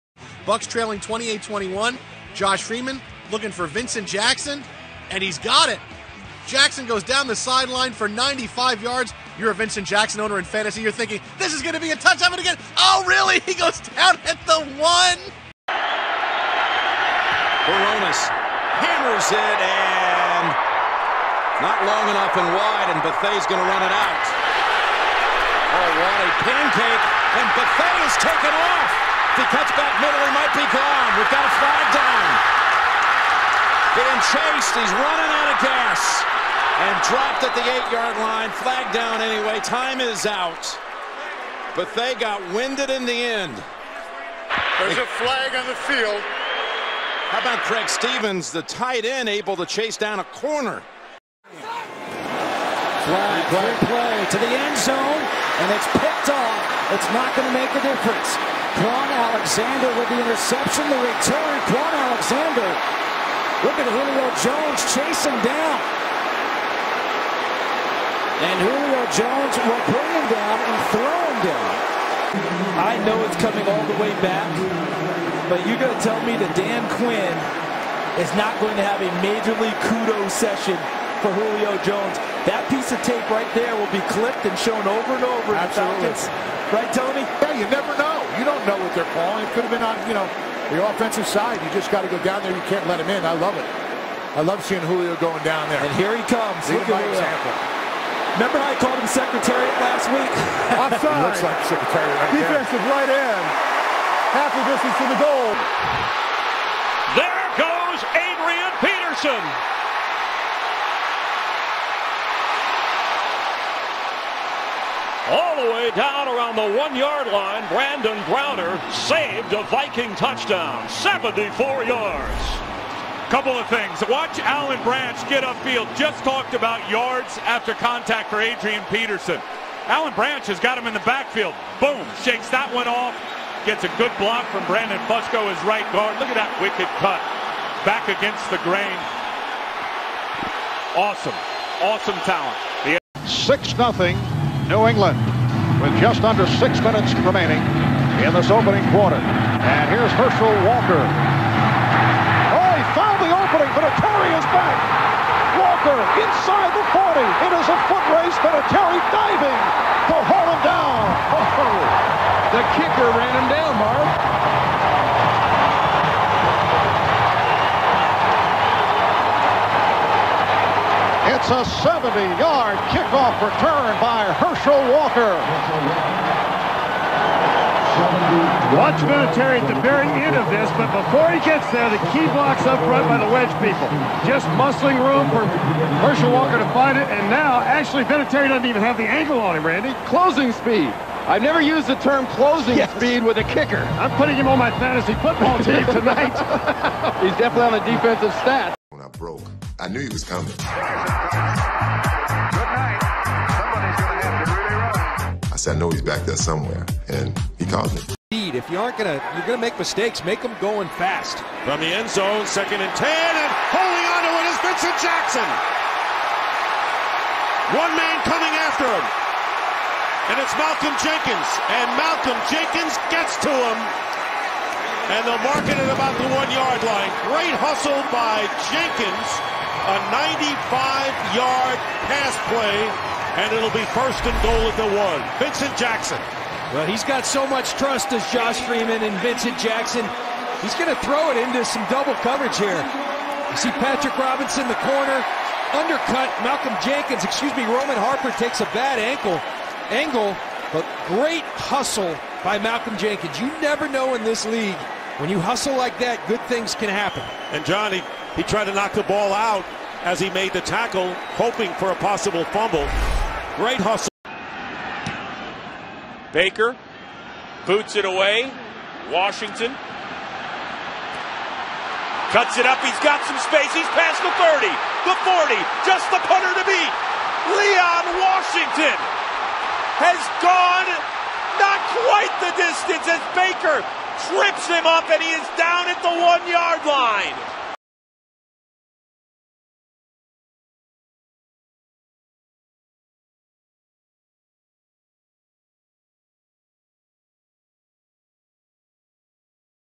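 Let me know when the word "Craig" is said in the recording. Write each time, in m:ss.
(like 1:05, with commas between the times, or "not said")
0:47.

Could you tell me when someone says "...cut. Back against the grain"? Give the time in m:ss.
2:16.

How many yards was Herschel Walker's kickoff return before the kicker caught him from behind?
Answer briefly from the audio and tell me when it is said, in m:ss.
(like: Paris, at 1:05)
70, at 2:51.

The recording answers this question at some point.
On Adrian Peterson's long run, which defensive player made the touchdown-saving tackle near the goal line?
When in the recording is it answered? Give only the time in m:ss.
1:57.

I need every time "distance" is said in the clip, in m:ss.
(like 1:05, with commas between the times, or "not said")
1:44, 4:42.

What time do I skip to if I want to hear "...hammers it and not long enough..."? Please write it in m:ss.
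0:18.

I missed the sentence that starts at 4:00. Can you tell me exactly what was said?
He's going to throw it into some double coverage here.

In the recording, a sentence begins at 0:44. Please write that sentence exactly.
There's a flag on the field.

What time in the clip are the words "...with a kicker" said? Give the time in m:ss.
3:13.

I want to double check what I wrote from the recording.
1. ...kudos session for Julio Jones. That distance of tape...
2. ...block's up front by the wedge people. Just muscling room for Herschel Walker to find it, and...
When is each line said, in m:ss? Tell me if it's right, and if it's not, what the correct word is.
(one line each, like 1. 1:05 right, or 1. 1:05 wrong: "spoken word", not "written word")
1. 1:19 wrong: "piece", not "distance"
2. 3:02 right.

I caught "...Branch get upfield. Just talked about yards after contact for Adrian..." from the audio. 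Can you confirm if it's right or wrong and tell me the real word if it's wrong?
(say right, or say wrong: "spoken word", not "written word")
right.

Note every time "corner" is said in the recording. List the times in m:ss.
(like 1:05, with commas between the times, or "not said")
0:50, 4:04.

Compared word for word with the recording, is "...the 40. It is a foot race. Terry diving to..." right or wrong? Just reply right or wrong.
right.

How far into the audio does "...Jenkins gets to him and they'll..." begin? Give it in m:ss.
3:42.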